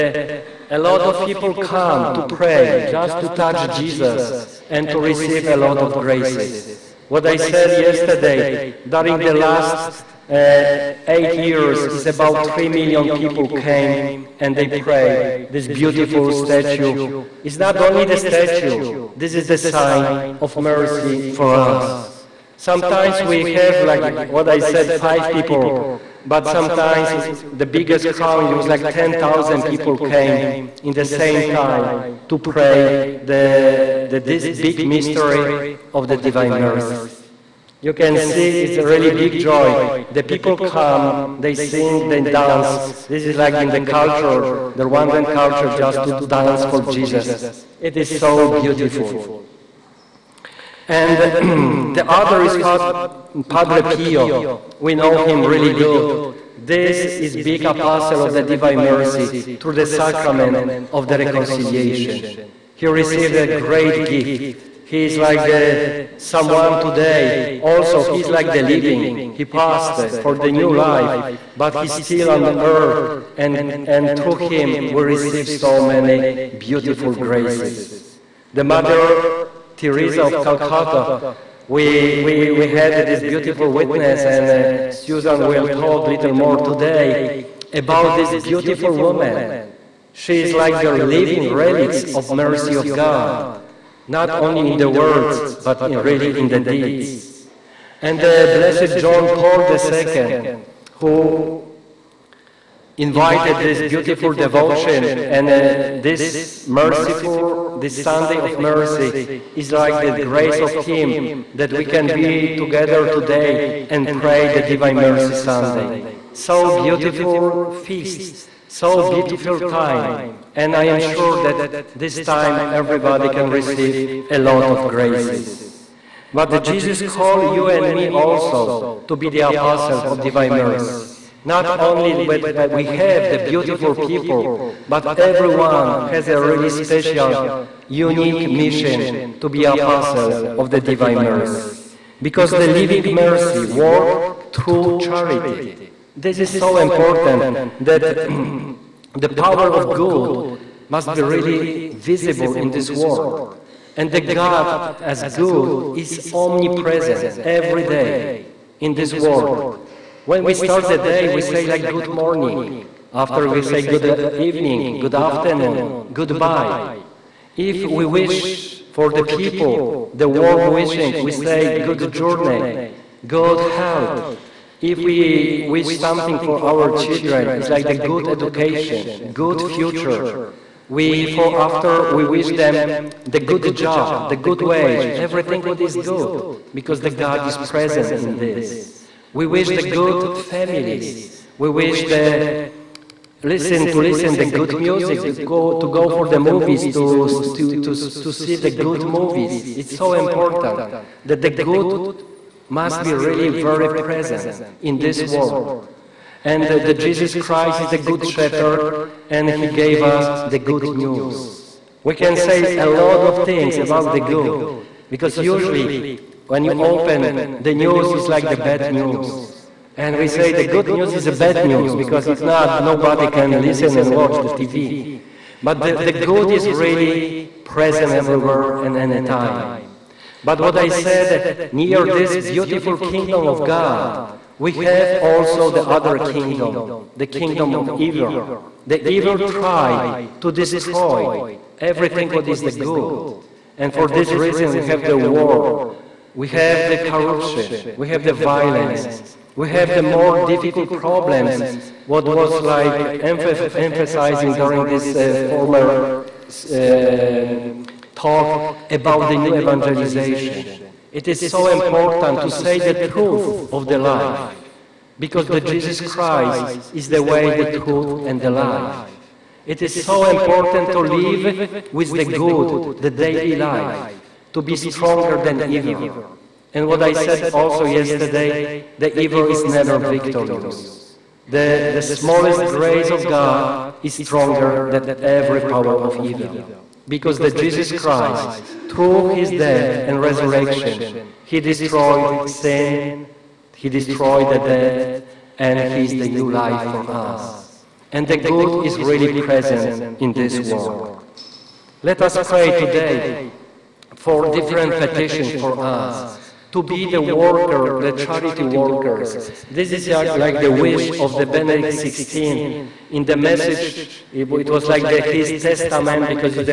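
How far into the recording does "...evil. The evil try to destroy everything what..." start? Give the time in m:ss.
3:58.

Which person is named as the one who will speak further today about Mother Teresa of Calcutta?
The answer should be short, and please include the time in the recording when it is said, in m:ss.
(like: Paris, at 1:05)
Susan, at 1:24.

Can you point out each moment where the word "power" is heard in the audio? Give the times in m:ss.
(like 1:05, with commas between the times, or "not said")
2:29, 4:45.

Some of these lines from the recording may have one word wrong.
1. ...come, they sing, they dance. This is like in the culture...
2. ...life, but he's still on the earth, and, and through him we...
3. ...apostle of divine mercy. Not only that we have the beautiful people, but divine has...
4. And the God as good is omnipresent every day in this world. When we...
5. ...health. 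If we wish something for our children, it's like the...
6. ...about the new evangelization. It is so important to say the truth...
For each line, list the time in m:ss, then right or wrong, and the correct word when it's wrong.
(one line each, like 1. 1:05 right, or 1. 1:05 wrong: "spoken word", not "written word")
1. 0:40 right
2. 1:10 right
3. 2:09 wrong: "everyone", not "divine"
4. 2:33 right
5. 2:53 right
6. 4:18 right.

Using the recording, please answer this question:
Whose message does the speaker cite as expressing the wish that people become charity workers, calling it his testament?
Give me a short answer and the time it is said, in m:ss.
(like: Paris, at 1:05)
Benedict XVI, at 5:11.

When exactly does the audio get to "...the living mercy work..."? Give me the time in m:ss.
2:22.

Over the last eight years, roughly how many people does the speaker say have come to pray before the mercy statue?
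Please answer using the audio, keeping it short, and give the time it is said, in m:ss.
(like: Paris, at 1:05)
3 million, at 0:12.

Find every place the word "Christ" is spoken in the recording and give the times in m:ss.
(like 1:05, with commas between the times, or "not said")
3:27, 4:26, 4:47.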